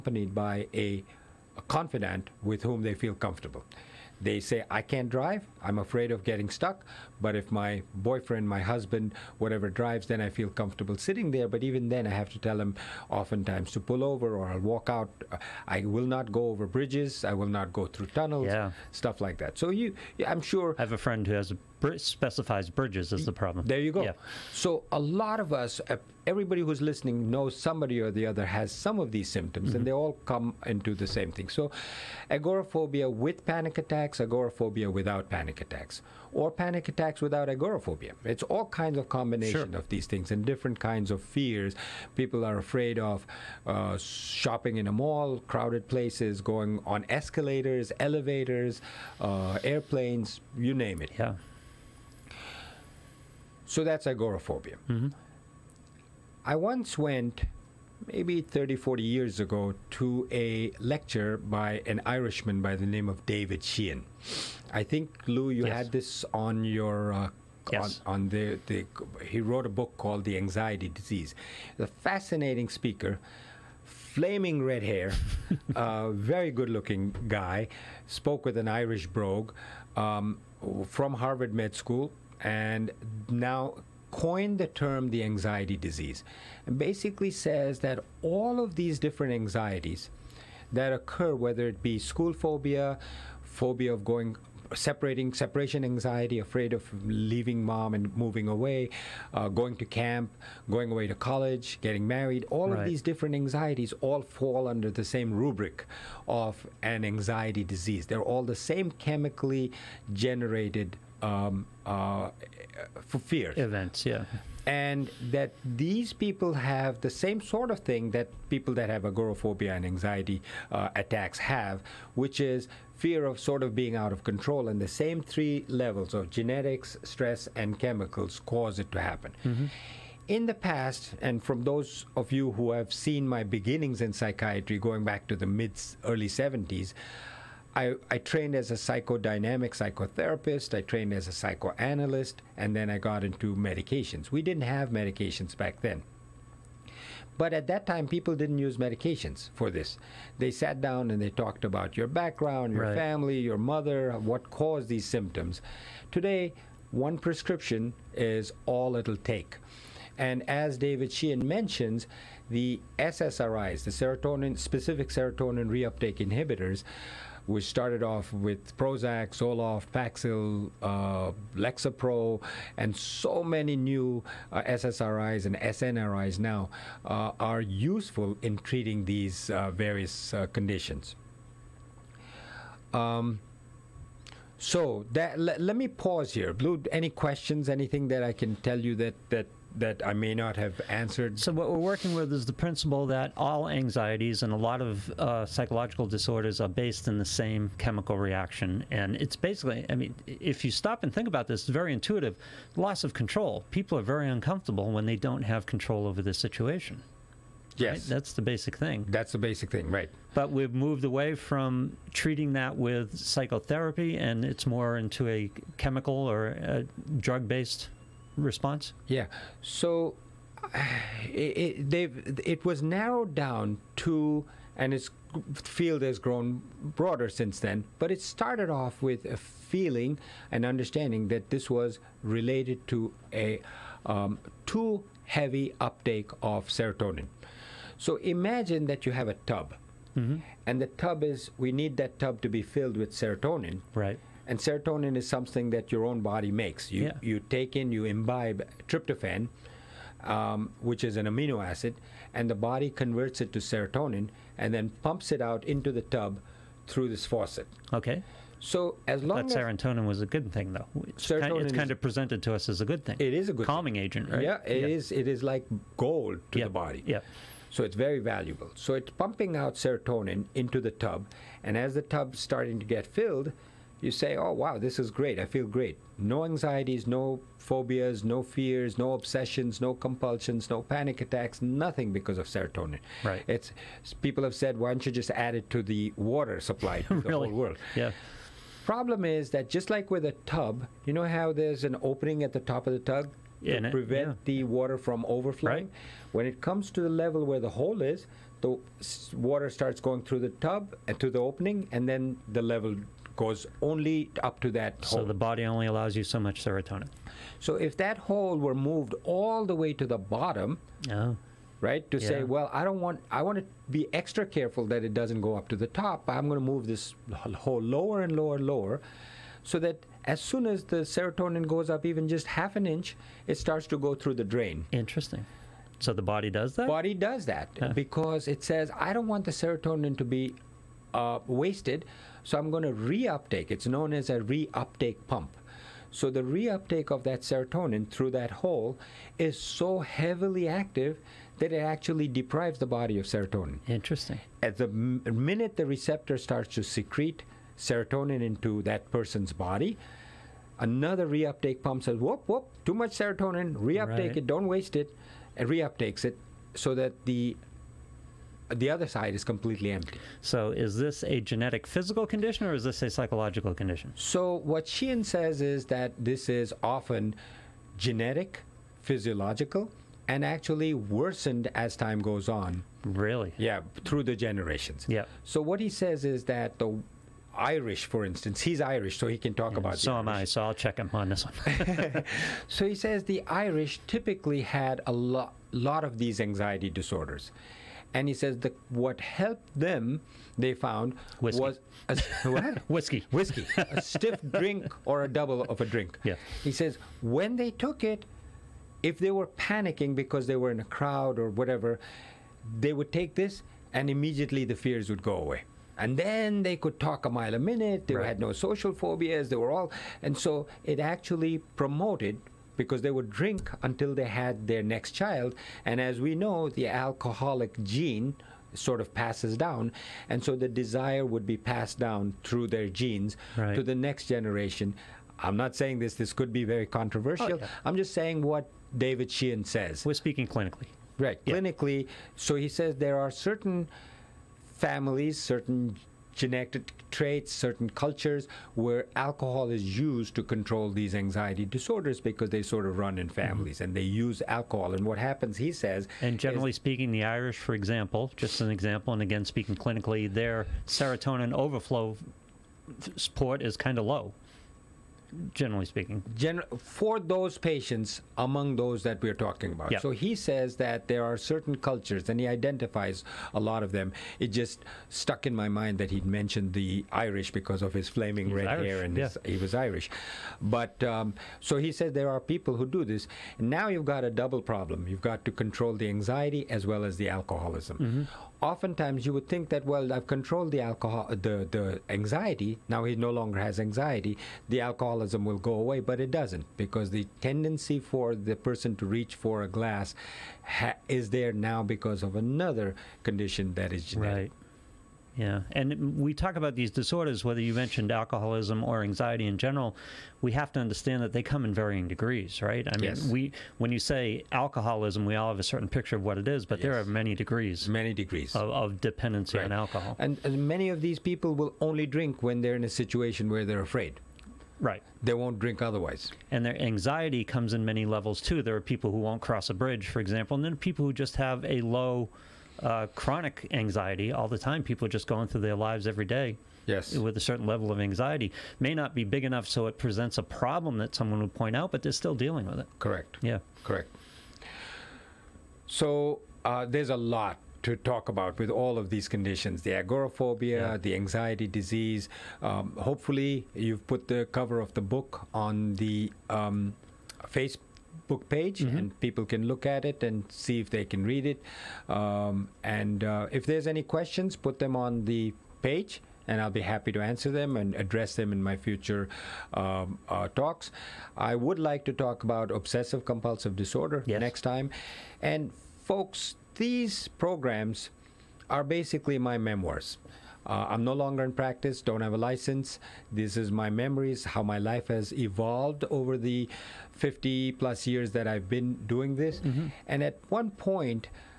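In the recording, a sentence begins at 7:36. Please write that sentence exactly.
Gen- for those patients among those that we're talking about.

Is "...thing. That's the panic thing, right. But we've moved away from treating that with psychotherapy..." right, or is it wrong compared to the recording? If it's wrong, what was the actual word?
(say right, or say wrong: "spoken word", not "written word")
wrong: "basic", not "panic".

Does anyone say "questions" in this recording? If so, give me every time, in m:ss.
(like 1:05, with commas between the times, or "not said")
3:07, 9:14.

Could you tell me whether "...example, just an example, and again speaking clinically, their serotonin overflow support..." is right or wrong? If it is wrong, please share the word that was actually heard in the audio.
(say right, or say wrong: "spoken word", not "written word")
right.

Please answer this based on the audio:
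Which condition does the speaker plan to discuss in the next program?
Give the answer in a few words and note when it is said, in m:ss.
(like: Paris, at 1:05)
obsessive compulsive disorder, at 9:22.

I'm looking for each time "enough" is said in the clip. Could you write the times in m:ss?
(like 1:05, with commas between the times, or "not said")
8:49.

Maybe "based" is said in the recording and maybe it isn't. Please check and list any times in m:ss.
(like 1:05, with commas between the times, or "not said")
3:16, 3:37.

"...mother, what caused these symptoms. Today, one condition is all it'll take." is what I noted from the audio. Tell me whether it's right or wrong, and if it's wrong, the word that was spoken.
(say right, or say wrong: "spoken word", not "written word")
wrong: "prescription", not "condition".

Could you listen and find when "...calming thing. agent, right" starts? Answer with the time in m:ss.
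4:23.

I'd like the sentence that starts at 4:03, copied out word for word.
Right and serotonin is something that your own body makes.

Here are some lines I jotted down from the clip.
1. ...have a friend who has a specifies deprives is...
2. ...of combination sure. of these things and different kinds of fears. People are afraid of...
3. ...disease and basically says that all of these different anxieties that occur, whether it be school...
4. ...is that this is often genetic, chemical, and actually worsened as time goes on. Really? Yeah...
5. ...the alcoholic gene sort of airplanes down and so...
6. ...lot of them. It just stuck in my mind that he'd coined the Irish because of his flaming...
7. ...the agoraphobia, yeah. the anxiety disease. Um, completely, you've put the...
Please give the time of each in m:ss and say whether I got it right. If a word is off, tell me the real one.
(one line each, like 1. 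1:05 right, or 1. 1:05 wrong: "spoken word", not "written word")
1. 0:20 wrong: "bridges", not "deprives"
2. 0:38 right
3. 1:25 right
4. 6:05 wrong: "physiological", not "chemical"
5. 6:56 wrong: "passes", not "airplanes"
6. 7:43 wrong: "mentioned", not "coined"
7. 8:59 wrong: "hopefully", not "completely".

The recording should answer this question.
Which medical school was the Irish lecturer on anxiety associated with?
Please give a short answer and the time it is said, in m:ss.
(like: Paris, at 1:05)
Harvard Med School, at 1:21.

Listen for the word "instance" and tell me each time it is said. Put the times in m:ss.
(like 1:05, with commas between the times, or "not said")
6:18.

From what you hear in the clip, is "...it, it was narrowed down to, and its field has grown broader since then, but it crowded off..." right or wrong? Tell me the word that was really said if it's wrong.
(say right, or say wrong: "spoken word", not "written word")
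wrong: "started", not "crowded".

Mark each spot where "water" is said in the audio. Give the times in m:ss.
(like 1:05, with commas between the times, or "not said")
4:46, 4:54, 4:59.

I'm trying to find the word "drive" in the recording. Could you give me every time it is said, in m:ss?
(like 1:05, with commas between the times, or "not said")
0:05, 0:09.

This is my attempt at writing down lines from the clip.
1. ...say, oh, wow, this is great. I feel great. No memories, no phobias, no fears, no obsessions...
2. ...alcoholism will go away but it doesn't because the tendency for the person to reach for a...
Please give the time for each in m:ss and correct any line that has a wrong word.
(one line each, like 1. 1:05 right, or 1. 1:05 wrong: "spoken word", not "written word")
1. 4:34 wrong: "anxieties", not "memories"
2. 8:04 right.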